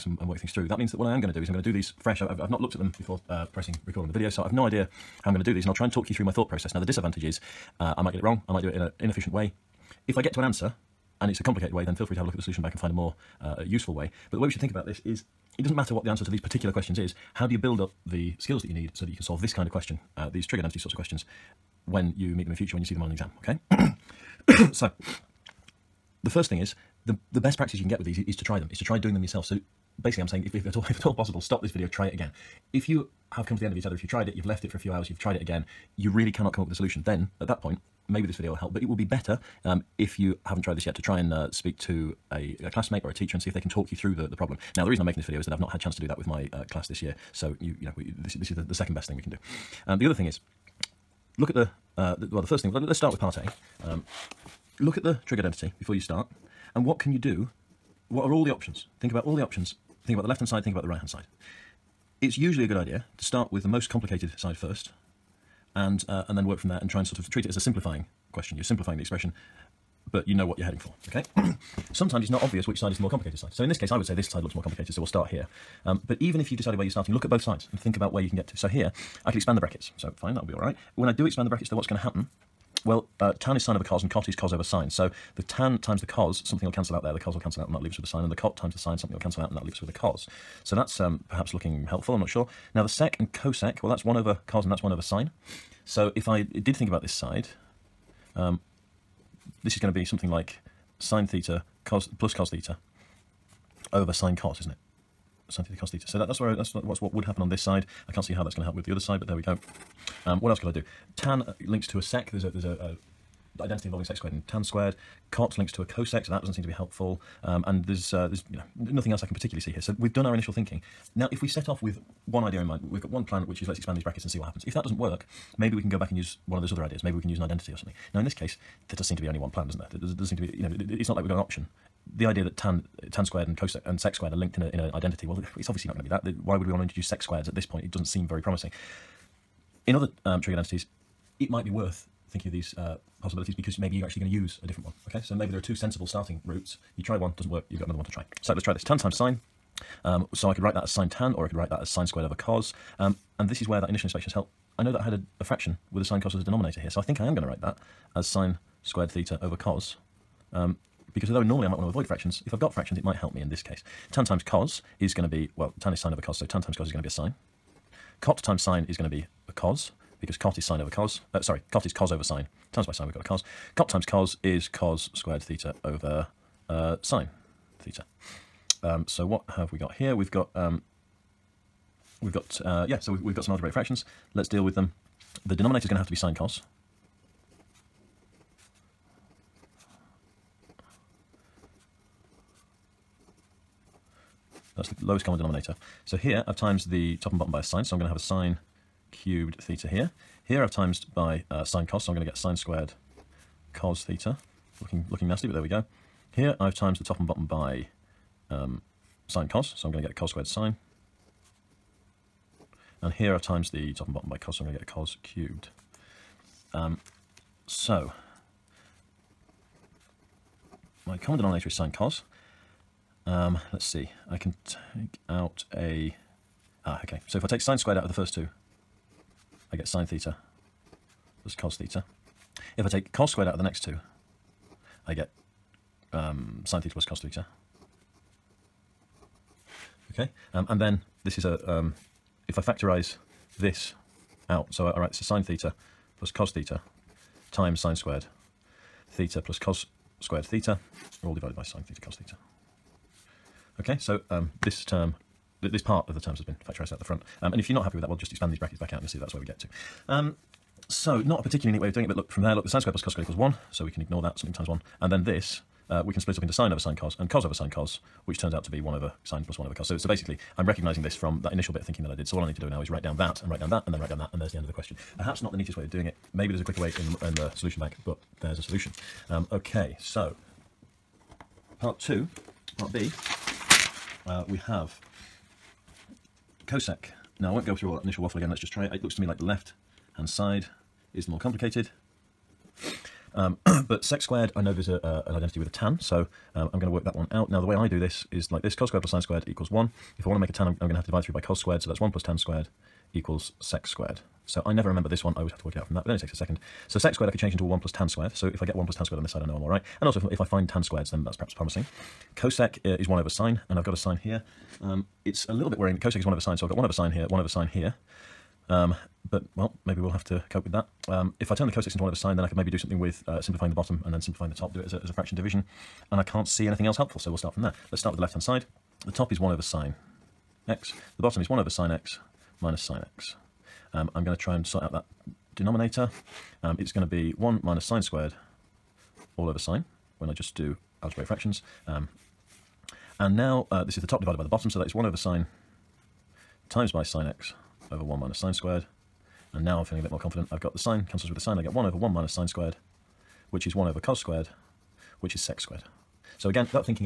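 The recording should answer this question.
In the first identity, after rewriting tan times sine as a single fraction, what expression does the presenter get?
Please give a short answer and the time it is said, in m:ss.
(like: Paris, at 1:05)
sine squared over cos, at 2:38.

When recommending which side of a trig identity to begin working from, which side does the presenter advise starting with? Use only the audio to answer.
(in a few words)
the most complicated side.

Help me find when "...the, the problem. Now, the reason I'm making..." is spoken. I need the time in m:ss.
0:44.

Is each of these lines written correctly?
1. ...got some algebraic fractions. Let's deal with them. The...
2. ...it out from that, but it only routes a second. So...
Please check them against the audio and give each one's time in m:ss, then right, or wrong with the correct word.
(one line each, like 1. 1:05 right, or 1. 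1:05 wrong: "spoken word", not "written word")
1. 3:03 right
2. 5:05 wrong: "takes", not "routes".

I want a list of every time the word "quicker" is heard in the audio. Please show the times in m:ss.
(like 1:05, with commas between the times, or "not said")
4:36.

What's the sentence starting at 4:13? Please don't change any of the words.
Okay, so um, this term this part of the terms has been factorised out the front.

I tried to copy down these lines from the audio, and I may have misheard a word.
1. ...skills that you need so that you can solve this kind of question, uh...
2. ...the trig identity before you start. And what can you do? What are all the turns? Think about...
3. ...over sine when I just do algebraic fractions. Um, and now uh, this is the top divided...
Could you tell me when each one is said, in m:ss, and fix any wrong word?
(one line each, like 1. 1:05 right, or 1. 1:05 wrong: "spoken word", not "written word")
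1. 0:18 right
2. 0:55 wrong: "options", not "turns"
3. 5:39 right.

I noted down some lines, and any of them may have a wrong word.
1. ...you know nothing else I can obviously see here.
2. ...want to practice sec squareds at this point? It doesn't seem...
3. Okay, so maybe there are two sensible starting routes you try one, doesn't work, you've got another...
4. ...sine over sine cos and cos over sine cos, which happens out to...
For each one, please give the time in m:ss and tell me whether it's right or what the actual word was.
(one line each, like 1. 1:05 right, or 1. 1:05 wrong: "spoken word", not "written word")
1. 1:58 wrong: "particularly", not "obviously"
2. 2:16 wrong: "introduce", not "practice"
3. 2:25 right
4. 4:26 wrong: "turns", not "happens".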